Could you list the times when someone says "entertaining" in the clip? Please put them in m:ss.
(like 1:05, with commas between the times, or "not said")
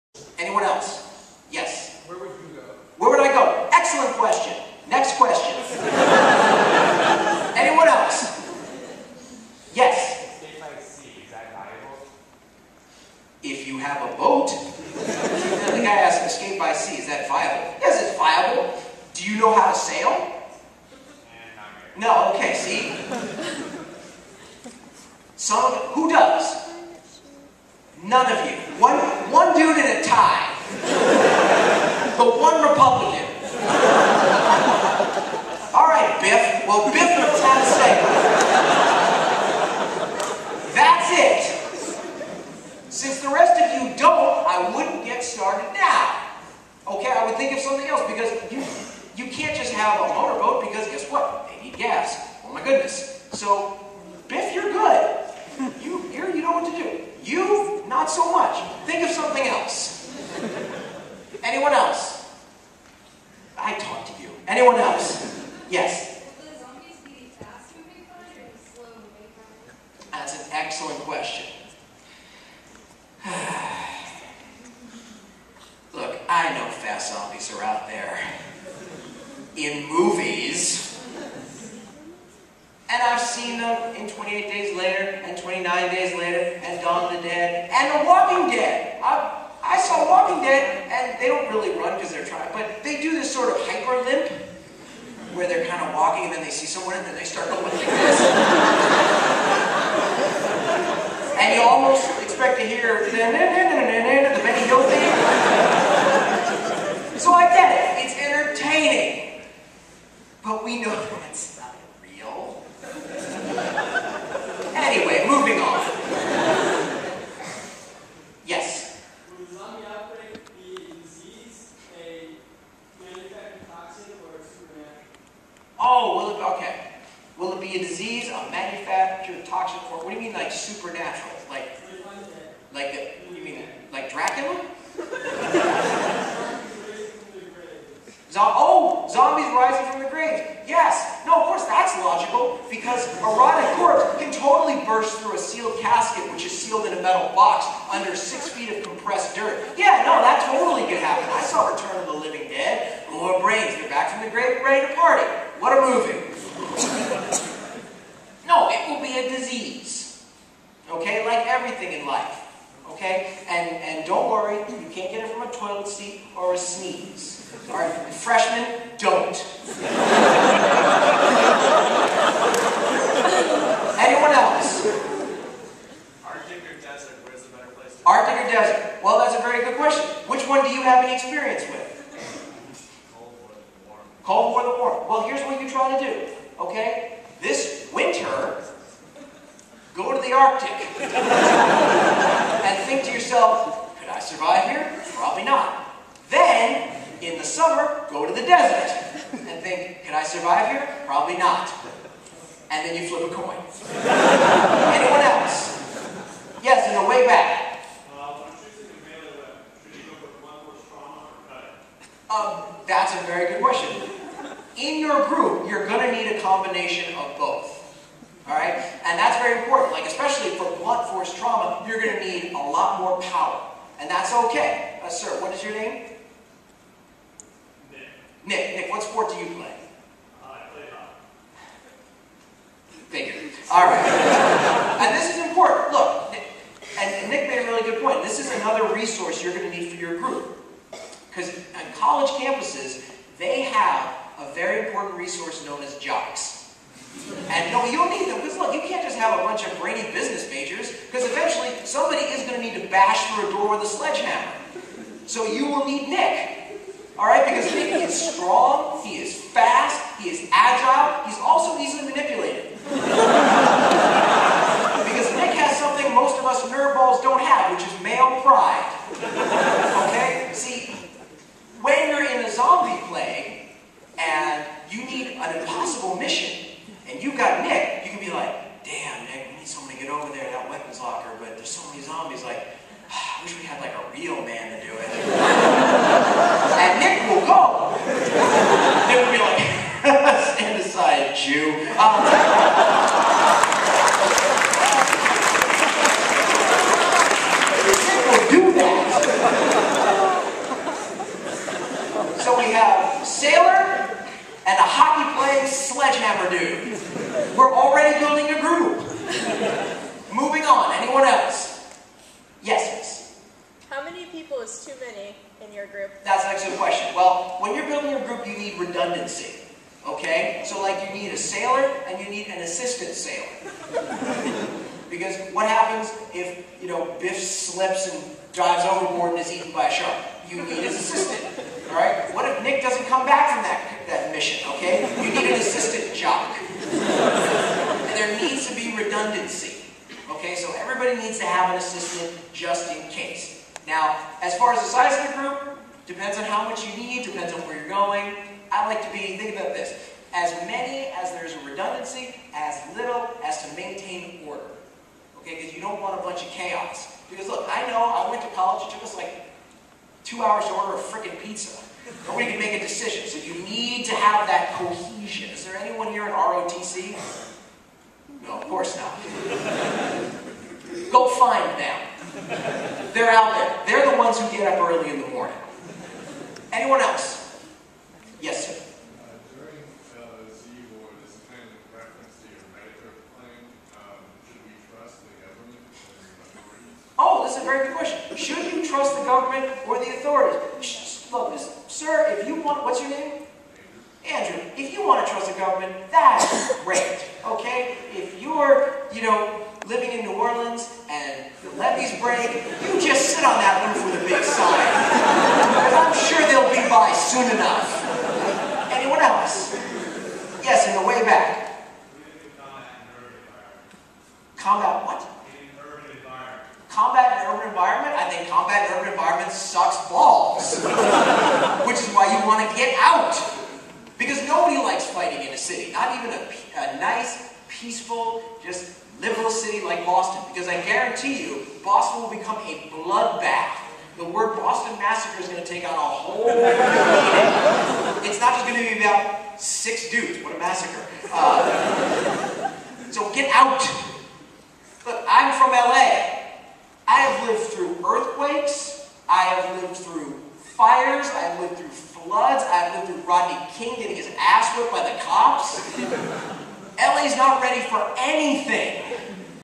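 1:48.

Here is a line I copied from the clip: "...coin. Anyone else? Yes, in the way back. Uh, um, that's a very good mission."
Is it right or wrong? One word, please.
wrong.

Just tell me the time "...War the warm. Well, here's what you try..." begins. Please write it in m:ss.
3:04.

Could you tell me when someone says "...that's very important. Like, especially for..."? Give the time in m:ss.
3:39.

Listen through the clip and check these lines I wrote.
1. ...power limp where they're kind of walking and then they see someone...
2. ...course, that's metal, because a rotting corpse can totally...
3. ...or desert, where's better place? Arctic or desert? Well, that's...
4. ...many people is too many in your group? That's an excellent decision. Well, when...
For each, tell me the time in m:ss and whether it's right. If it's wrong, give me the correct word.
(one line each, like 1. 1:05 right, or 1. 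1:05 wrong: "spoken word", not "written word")
1. 1:33 wrong: "hyper", not "power"
2. 2:21 wrong: "logical", not "metal"
3. 2:56 right
4. 5:14 wrong: "question", not "decision".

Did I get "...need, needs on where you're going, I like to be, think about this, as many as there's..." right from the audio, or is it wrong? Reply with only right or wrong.
wrong.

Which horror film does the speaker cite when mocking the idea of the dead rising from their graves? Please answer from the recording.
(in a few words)
Return of the Living Dead.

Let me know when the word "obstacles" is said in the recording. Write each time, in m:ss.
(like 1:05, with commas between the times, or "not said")
not said.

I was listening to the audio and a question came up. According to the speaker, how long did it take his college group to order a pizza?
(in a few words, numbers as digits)
2 hours.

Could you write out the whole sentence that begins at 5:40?
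Okay, so everybody needs to have an assistant just in case.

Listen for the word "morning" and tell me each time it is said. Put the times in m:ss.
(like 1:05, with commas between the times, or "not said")
6:15.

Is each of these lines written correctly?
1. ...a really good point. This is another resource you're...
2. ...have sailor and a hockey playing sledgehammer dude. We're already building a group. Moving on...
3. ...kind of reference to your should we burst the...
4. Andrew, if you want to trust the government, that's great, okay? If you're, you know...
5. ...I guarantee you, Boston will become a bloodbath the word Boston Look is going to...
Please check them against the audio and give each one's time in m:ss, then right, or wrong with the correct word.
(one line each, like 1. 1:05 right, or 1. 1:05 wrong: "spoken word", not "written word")
1. 3:57 right
2. 5:02 right
3. 6:21 wrong: "trust", not "burst"
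4. 6:34 right
5. 7:10 wrong: "Massacre", not "Look".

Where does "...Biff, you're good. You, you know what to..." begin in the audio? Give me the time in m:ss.
0:54.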